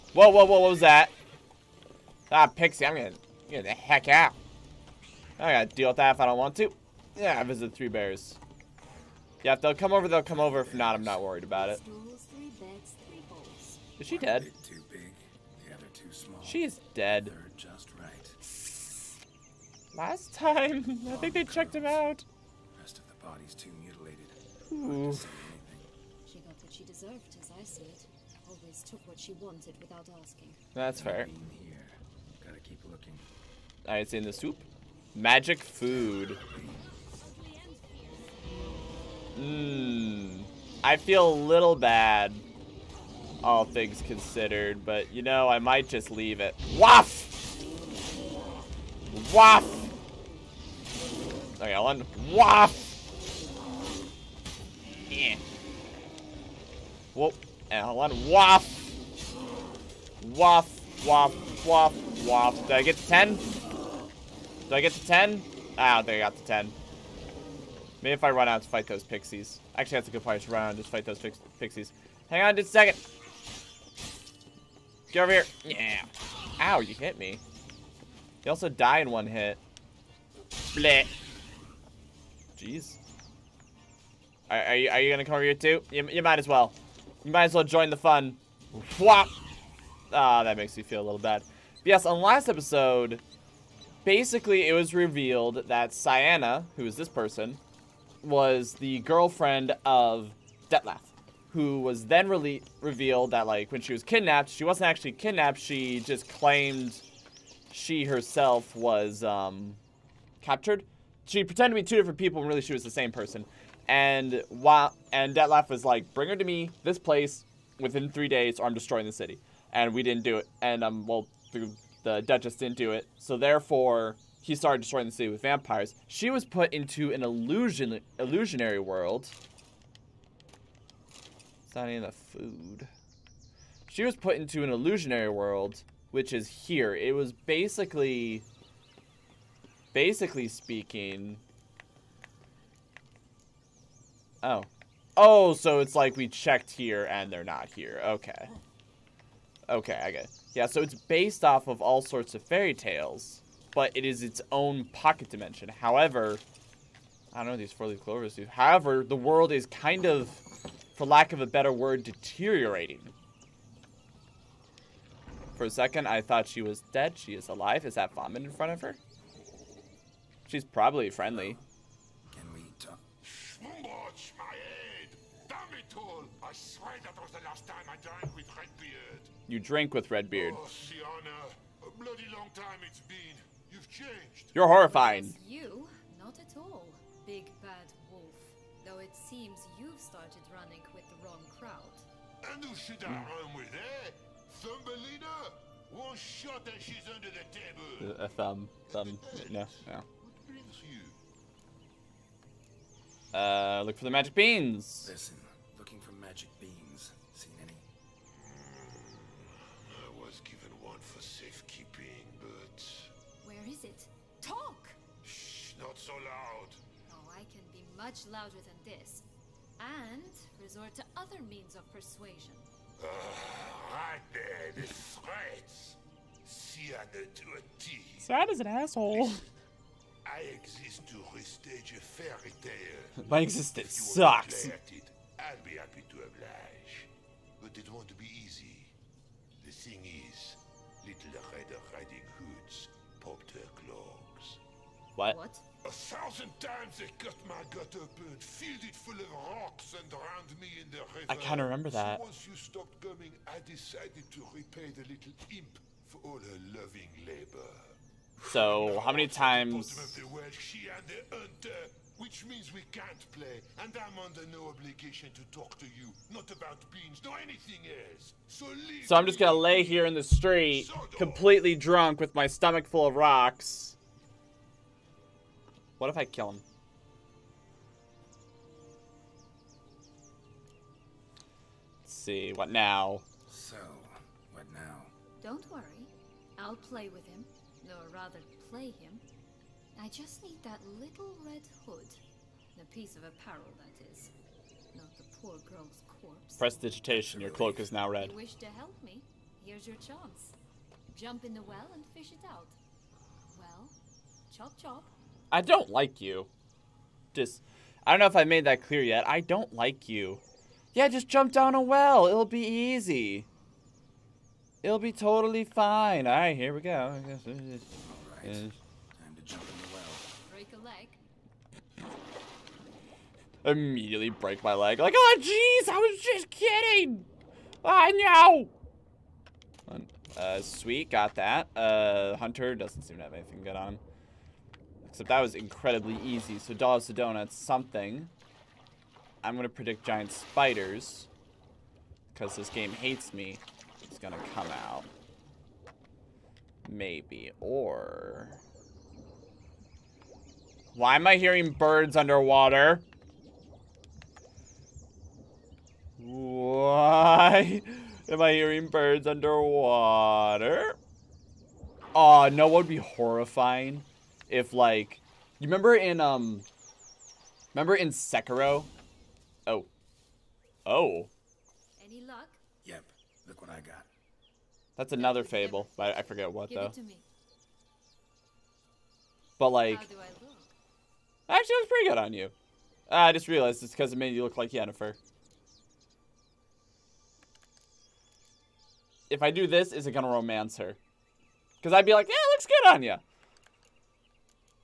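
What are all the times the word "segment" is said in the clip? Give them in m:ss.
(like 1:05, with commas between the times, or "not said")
not said.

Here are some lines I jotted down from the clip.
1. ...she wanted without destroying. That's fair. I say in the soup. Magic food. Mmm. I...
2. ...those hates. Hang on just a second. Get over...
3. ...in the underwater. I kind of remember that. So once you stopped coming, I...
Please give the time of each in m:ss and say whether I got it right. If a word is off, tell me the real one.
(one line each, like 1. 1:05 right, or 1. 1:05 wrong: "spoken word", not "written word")
1. 0:29 wrong: "asking", not "destroying"
2. 1:11 wrong: "pixies", not "hates"
3. 4:10 wrong: "river", not "underwater".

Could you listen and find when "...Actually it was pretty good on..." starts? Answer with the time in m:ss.
6:19.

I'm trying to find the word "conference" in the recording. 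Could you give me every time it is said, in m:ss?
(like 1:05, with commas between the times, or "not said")
not said.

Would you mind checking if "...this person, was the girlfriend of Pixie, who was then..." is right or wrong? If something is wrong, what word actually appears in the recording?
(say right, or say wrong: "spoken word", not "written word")
wrong: "Dettlaff", not "Pixie".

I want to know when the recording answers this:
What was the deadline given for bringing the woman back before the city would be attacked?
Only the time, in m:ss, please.
1:58.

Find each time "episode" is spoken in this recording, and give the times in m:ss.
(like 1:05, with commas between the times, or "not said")
1:32.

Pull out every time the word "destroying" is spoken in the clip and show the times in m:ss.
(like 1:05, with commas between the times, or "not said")
1:58, 2:04.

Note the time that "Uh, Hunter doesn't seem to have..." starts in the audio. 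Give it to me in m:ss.
5:31.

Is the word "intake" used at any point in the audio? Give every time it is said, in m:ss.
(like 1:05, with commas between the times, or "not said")
not said.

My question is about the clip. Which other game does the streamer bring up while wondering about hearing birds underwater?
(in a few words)
Sekiro.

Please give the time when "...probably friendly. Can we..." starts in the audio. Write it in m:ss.
2:50.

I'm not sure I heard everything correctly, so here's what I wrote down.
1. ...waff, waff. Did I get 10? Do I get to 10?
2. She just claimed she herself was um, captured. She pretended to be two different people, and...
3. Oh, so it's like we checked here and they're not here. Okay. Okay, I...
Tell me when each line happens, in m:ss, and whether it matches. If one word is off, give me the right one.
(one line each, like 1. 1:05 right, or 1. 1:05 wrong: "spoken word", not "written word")
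1. 1:01 right
2. 1:45 right
3. 2:25 right.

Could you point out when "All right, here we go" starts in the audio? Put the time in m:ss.
5:16.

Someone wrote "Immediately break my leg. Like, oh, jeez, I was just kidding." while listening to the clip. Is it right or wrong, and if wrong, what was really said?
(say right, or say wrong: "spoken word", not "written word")
right.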